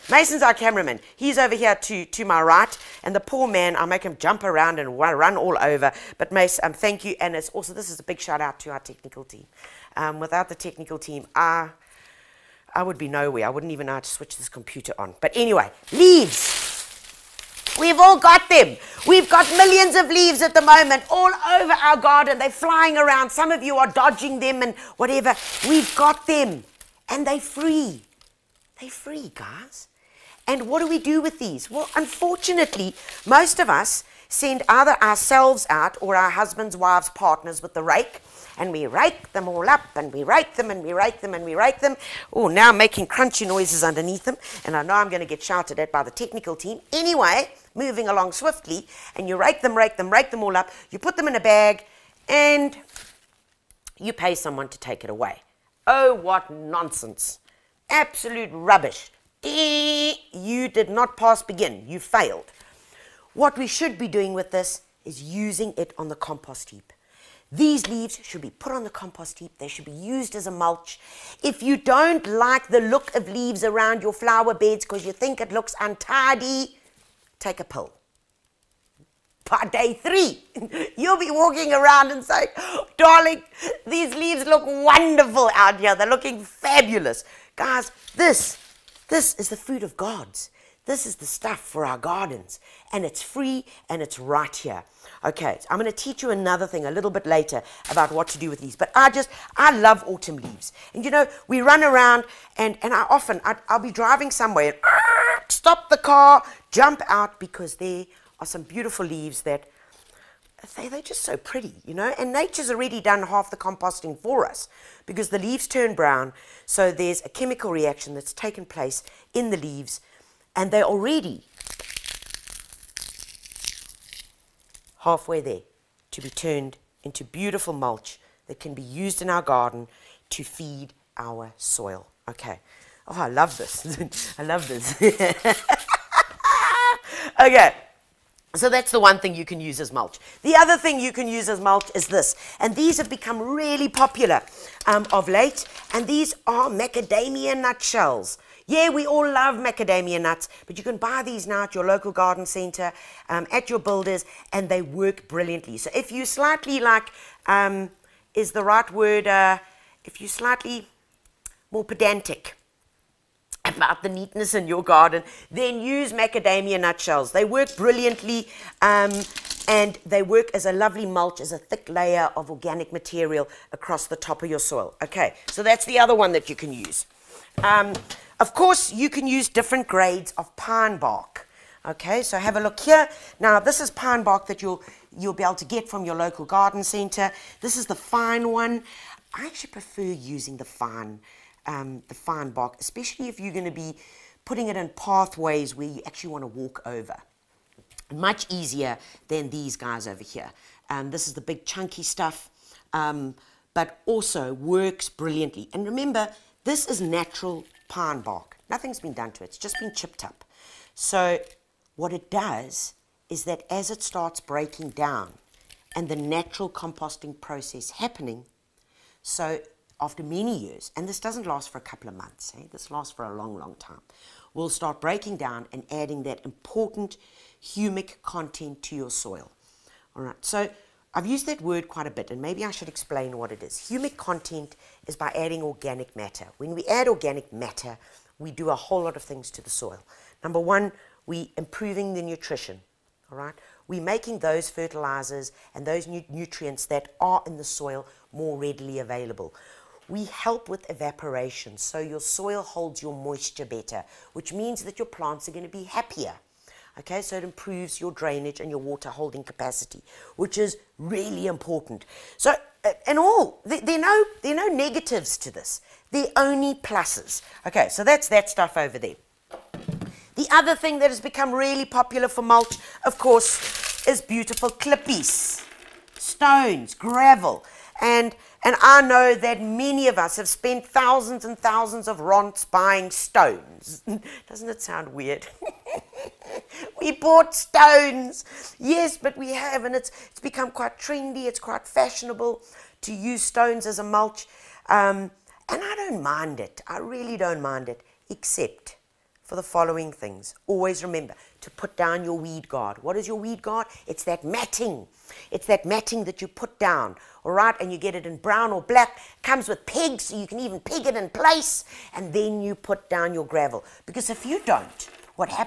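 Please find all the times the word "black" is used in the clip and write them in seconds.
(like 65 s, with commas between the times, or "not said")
308 s.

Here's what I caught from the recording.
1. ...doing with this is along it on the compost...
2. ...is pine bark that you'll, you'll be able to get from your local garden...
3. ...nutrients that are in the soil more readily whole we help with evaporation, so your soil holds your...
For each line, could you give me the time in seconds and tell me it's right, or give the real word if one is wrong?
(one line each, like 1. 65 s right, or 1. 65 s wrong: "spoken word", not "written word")
1. 64 s wrong: "using", not "along"
2. 183 s right
3. 246 s wrong: "available", not "whole".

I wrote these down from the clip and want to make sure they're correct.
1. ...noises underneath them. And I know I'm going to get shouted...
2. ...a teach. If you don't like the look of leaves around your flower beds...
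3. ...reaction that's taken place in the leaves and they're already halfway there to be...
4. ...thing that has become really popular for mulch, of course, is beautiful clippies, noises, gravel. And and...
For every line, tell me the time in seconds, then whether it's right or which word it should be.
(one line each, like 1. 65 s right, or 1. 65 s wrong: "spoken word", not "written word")
1. 43 s right
2. 70 s wrong: "mulch", not "teach"
3. 117 s right
4. 270 s wrong: "stones", not "noises".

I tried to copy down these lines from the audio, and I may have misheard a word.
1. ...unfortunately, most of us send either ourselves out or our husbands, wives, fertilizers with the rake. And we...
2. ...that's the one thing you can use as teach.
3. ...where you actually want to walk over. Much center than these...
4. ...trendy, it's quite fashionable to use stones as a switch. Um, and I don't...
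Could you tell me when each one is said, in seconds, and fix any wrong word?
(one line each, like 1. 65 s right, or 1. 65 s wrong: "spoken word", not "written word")
1. 31 s wrong: "partners", not "fertilizers"
2. 138 s wrong: "mulch", not "teach"
3. 195 s wrong: "easier", not "center"
4. 290 s wrong: "mulch", not "switch".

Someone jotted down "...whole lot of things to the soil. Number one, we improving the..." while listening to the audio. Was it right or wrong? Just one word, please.
right.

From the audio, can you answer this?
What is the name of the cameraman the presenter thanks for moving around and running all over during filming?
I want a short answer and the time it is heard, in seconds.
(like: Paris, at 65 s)
Mason, at 0 s.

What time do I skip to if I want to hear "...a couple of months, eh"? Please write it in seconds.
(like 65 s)
221 s.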